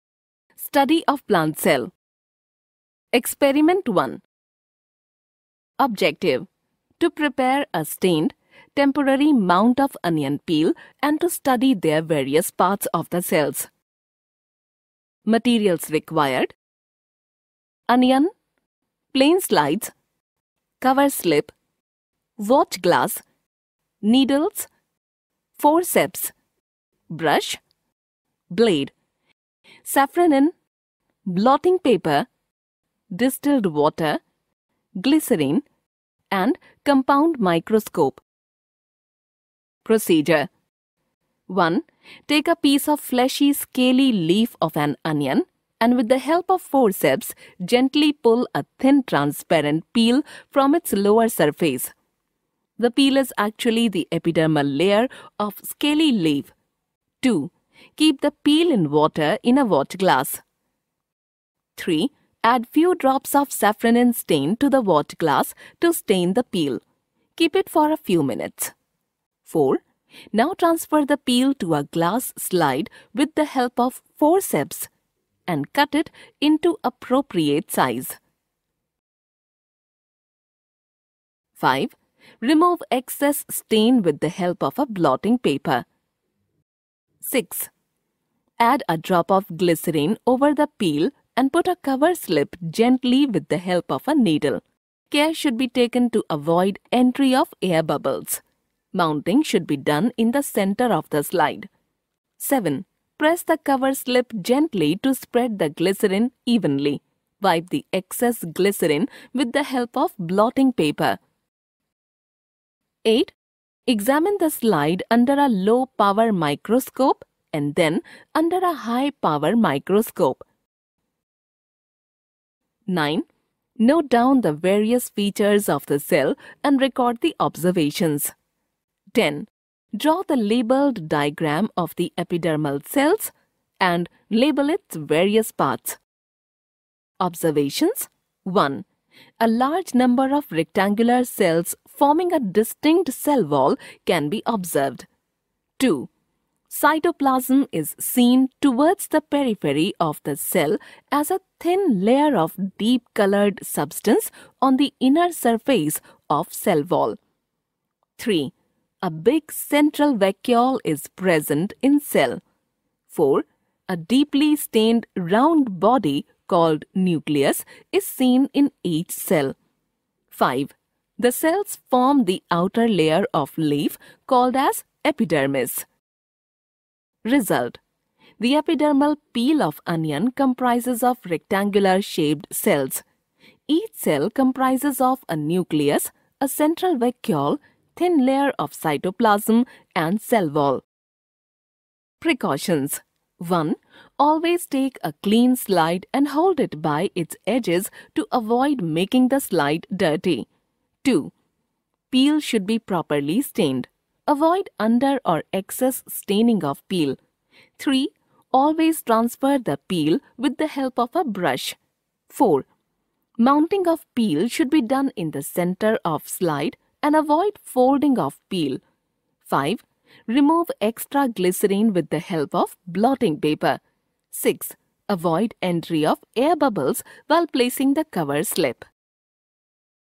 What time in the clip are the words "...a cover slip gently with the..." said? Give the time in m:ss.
1:31.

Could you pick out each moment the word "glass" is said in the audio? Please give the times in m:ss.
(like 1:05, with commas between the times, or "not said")
0:22, 0:59, 1:05, 1:11.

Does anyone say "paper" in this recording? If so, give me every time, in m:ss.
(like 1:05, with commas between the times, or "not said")
0:31, 1:25, 1:50, 3:43.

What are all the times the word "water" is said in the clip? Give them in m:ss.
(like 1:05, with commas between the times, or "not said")
0:33, 0:58, 1:04.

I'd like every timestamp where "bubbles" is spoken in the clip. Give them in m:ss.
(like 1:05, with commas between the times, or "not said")
1:37, 3:46.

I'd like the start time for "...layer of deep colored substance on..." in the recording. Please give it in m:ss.
2:32.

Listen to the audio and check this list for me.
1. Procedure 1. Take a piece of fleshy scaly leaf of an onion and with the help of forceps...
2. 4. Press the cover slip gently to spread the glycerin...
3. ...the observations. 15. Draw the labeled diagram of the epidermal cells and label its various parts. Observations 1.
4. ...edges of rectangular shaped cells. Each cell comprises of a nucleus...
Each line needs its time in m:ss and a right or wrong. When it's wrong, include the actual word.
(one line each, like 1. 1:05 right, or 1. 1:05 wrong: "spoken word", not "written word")
1. 0:39 right
2. 1:42 wrong: "7", not "4"
3. 2:07 wrong: "10", not "15"
4. 3:00 wrong: "comprises", not "edges".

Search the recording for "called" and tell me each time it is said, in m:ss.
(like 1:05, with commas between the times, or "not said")
2:46, 2:54.